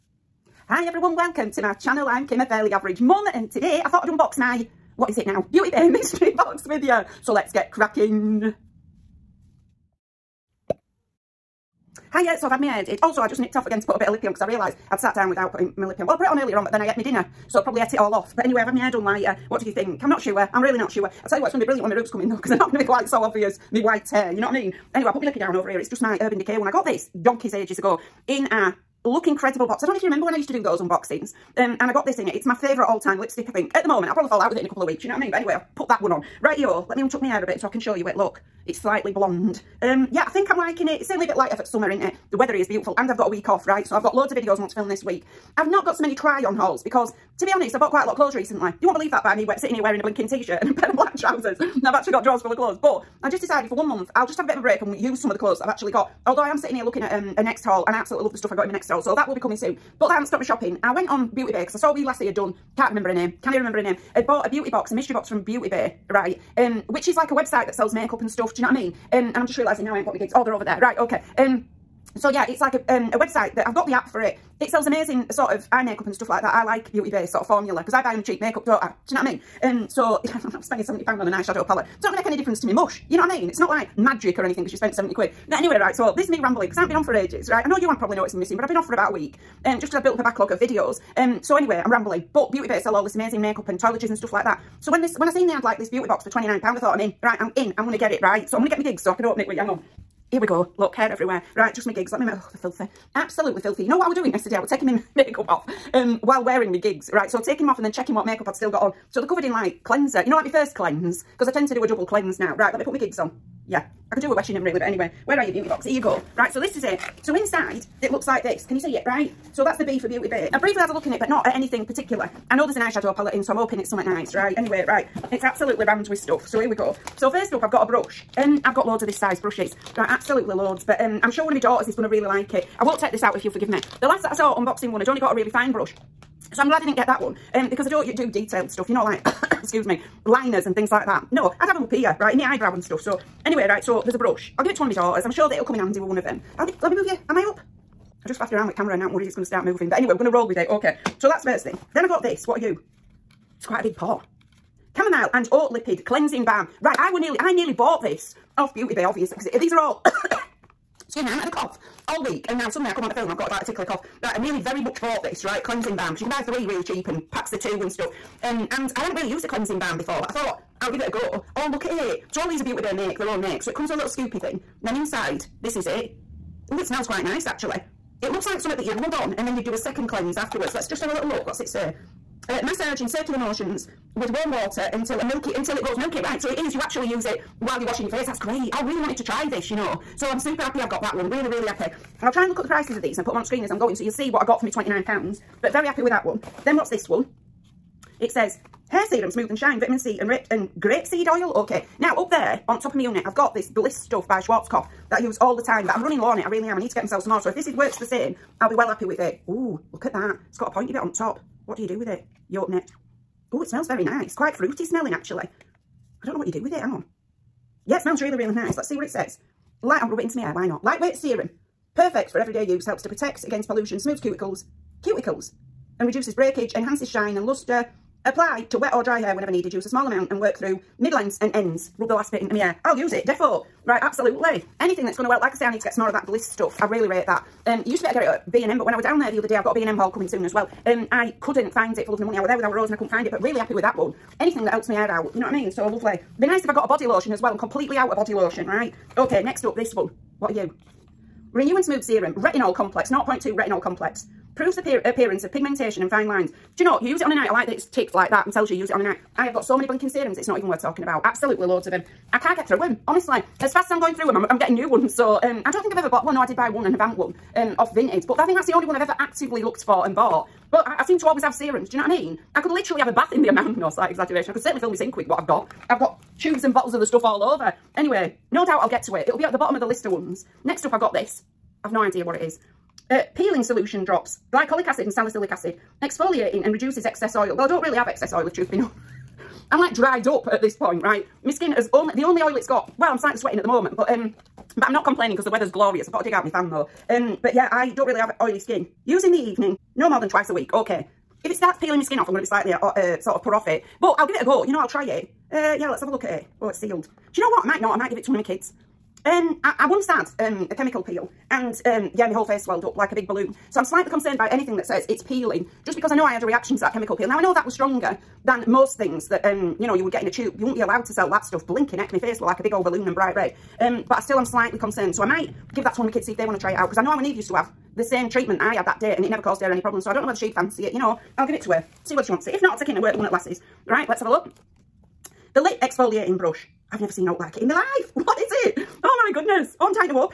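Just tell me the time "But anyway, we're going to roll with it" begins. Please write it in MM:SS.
02:29.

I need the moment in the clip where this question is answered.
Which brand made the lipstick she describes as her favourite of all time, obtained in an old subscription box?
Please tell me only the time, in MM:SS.
00:26.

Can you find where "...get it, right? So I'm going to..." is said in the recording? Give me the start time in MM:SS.
01:37.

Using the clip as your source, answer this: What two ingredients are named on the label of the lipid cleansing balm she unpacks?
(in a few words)
Chamomile and oat.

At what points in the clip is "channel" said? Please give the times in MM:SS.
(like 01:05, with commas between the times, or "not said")
00:01.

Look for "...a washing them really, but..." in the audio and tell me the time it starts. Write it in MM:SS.
01:54.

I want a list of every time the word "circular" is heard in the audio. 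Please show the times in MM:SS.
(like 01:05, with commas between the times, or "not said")
03:03.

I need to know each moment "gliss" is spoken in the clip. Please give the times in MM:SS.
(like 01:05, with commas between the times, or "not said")
03:23, 03:56.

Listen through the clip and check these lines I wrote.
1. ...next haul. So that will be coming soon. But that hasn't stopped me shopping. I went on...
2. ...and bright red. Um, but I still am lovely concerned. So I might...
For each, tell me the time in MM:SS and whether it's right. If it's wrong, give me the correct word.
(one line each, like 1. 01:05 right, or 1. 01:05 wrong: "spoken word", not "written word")
1. 00:58 right
2. 05:23 wrong: "slightly", not "lovely".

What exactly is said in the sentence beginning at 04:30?
But I, I seem to always have serums, do you know what I mean?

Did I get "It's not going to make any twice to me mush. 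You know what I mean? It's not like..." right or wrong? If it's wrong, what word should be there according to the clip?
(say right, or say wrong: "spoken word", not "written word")
wrong: "difference", not "twice".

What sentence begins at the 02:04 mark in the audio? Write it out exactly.
Anyway, right, it's absolutely rammed with stuff.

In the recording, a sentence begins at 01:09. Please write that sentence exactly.
Um, and I'm just realising now I ain't got my gigs.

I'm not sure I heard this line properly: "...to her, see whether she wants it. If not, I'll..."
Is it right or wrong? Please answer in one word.
right.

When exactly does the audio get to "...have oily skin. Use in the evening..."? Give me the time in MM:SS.
04:58.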